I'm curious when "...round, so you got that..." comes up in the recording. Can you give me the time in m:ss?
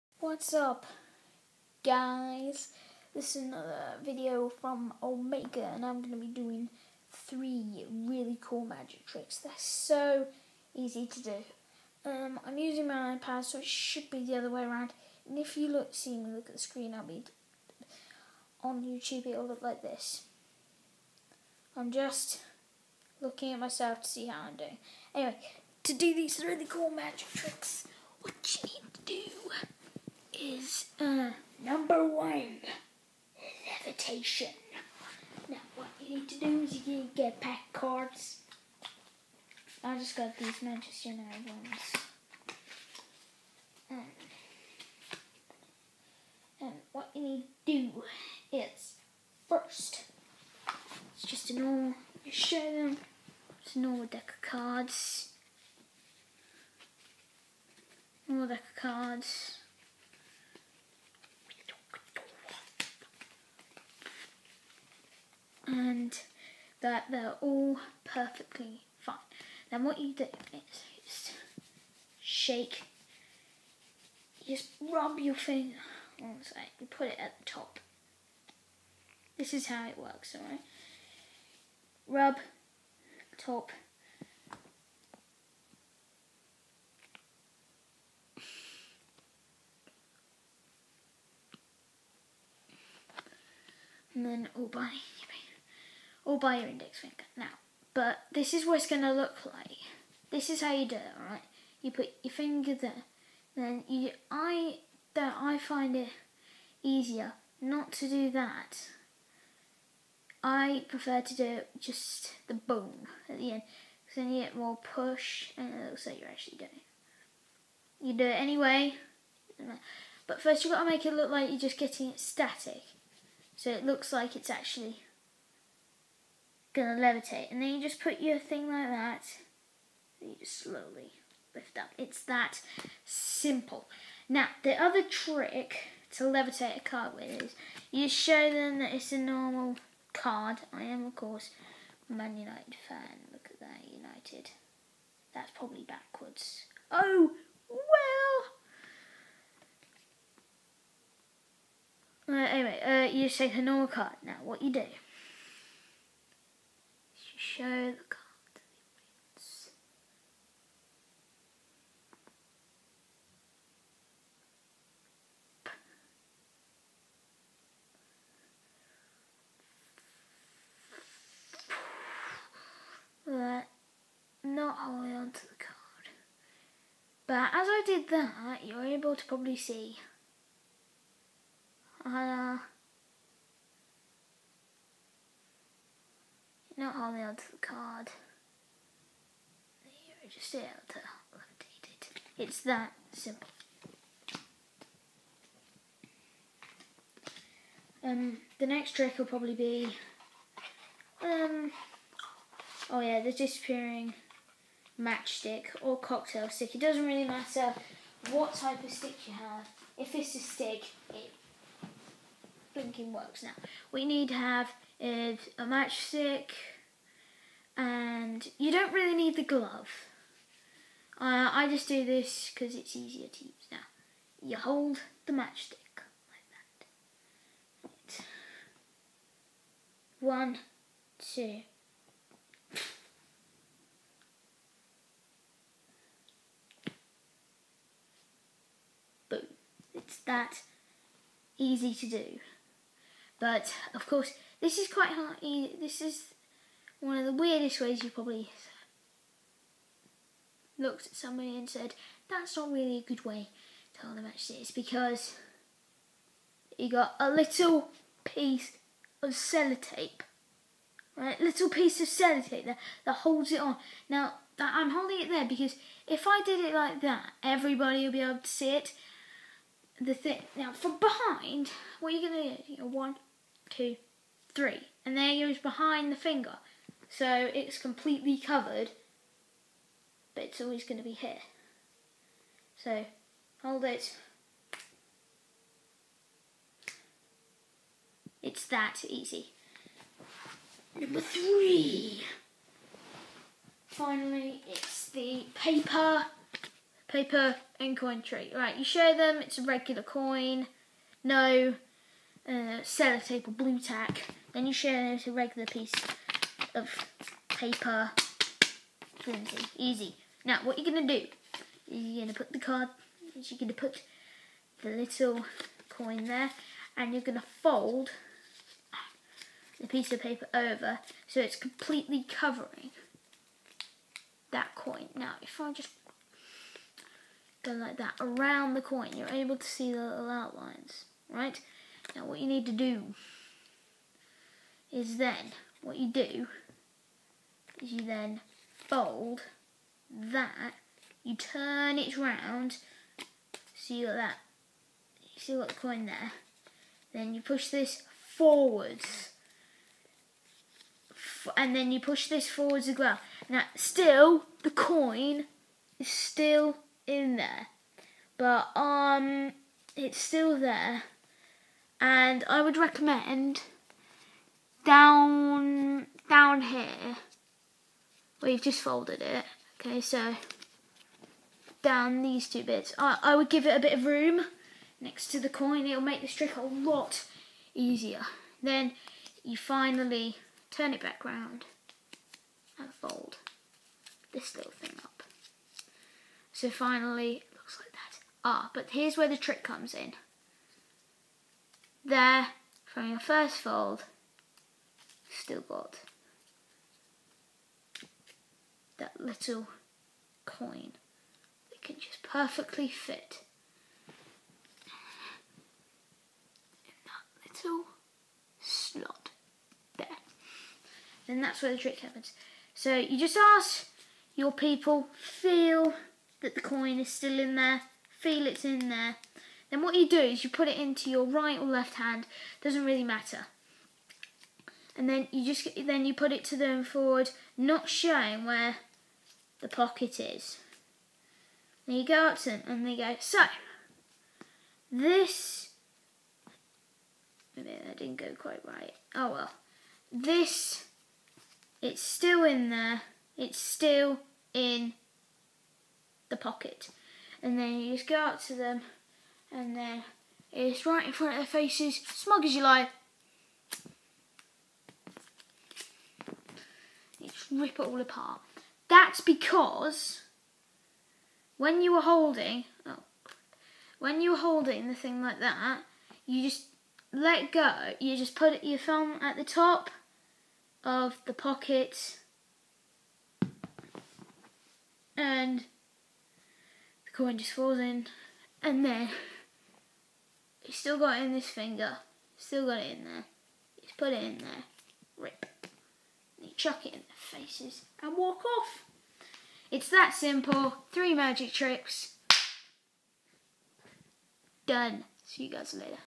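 5:42.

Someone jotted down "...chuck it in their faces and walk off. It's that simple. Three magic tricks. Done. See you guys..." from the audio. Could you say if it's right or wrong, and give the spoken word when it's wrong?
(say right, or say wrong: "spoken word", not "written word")
right.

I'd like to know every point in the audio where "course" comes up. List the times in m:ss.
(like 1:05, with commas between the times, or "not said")
2:21, 4:04.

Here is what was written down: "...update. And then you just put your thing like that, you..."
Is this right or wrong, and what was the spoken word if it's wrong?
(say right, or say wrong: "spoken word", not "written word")
wrong: "levitate", not "update".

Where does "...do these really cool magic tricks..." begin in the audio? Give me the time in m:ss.
0:25.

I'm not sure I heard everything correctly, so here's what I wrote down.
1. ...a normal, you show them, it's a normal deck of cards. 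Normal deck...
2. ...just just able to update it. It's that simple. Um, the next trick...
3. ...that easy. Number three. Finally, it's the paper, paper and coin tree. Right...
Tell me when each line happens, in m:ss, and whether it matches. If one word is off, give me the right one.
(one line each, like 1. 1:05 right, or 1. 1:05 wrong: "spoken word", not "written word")
1. 0:51 right
2. 3:10 right
3. 4:48 right.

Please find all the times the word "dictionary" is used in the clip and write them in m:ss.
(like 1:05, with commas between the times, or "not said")
not said.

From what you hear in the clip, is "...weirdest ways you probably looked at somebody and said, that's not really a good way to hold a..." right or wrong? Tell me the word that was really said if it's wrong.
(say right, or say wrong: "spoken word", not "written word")
right.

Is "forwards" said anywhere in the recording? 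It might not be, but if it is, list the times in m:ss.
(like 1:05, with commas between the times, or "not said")
5:48, 5:52, 7:06.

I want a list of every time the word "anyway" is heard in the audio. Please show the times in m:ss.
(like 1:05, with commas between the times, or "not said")
0:25, 1:58, 2:32.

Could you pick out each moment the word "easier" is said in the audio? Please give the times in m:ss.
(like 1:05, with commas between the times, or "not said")
1:46, 3:42, 6:17.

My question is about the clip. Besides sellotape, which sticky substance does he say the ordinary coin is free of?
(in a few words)
Blu Tack.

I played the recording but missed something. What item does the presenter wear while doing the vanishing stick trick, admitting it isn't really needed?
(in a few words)
Glove.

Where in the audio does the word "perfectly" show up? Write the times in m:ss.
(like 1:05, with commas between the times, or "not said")
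1:08, 6:42.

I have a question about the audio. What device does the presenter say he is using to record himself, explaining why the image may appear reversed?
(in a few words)
iPad.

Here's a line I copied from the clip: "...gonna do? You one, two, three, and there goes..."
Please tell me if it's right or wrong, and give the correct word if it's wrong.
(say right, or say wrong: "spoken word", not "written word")
right.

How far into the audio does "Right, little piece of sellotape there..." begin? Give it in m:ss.
4:21.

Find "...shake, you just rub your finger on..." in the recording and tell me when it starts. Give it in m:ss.
1:12.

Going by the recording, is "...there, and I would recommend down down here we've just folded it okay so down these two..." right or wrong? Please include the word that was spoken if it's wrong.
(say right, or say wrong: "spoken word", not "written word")
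right.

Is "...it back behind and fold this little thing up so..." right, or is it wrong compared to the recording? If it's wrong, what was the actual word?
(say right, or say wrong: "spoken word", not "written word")
wrong: "round", not "behind".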